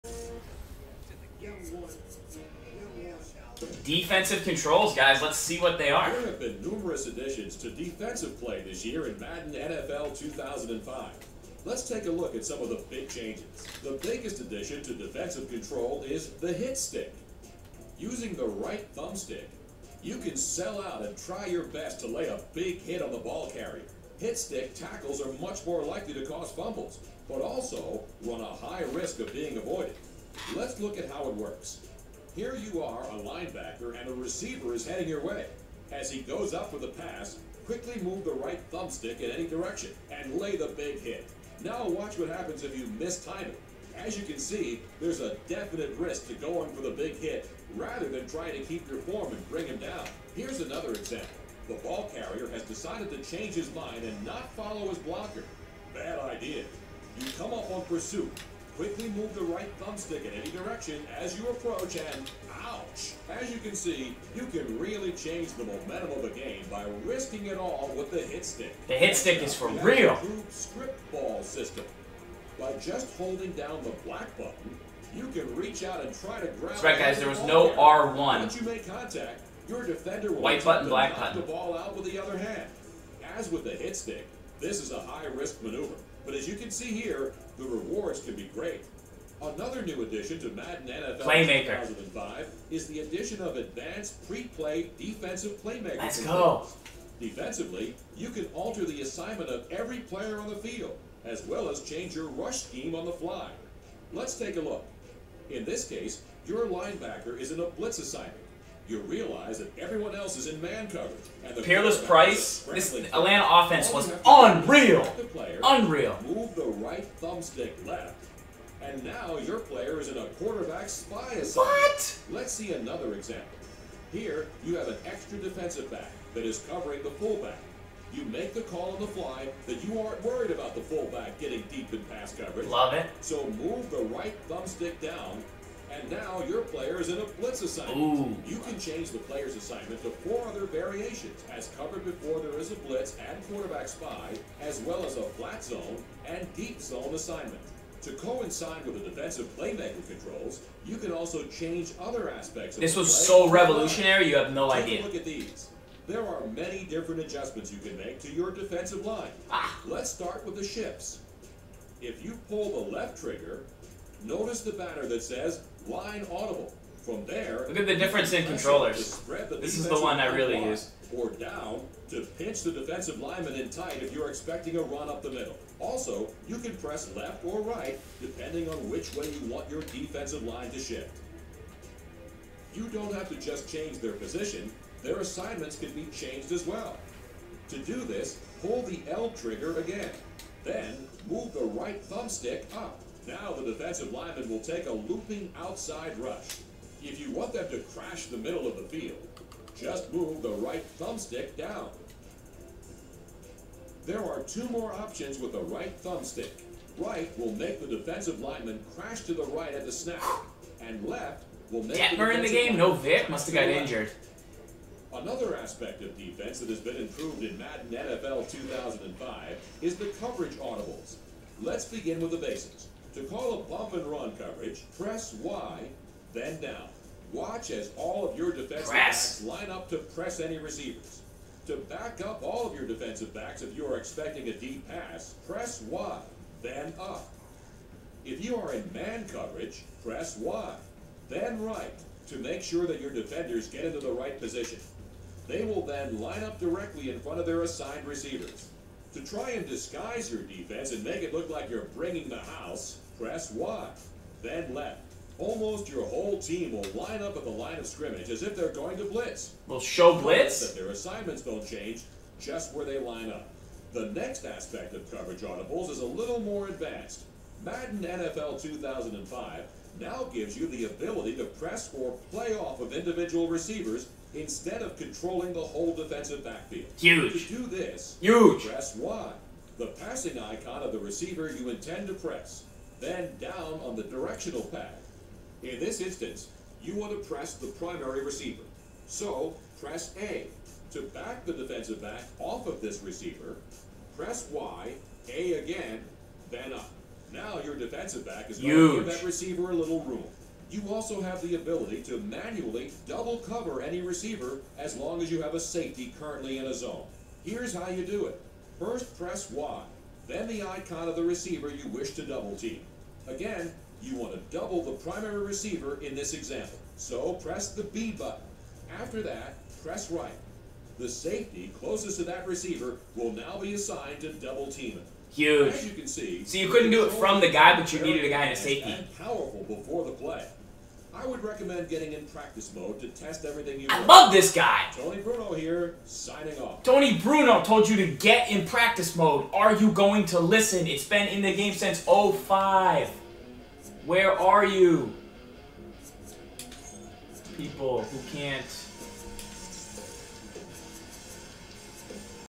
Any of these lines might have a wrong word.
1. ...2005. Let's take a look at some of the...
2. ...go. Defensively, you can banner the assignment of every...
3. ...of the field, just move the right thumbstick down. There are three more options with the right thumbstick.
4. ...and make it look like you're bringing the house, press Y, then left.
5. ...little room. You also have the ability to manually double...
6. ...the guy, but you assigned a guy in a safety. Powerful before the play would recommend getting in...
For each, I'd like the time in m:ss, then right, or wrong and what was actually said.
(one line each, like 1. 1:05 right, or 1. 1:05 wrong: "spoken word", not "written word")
1. 0:10 right
2. 1:36 wrong: "alter", not "banner"
3. 3:18 wrong: "two", not "three"
4. 4:10 right
5. 4:59 right
6. 5:27 wrong: "needed", not "assigned".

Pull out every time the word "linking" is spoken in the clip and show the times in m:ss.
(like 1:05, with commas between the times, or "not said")
not said.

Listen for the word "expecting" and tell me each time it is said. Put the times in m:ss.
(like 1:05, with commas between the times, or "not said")
2:54, 3:53.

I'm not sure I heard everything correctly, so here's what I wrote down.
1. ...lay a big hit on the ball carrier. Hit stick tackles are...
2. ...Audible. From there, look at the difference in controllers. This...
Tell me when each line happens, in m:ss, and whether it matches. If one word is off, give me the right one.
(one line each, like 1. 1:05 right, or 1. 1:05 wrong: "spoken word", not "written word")
1. 0:22 right
2. 2:46 right.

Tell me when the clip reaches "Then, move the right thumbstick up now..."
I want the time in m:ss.
3:10.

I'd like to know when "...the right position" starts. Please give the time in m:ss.
4:03.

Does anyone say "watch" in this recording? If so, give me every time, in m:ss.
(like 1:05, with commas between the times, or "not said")
0:41, 3:47.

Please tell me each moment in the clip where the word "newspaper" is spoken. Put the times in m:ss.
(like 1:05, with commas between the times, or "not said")
not said.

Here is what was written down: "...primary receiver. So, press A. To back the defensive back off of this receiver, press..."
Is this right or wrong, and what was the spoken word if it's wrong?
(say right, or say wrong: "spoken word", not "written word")
right.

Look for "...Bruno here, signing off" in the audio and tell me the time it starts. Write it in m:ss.
5:35.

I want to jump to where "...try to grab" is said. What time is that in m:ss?
1:16.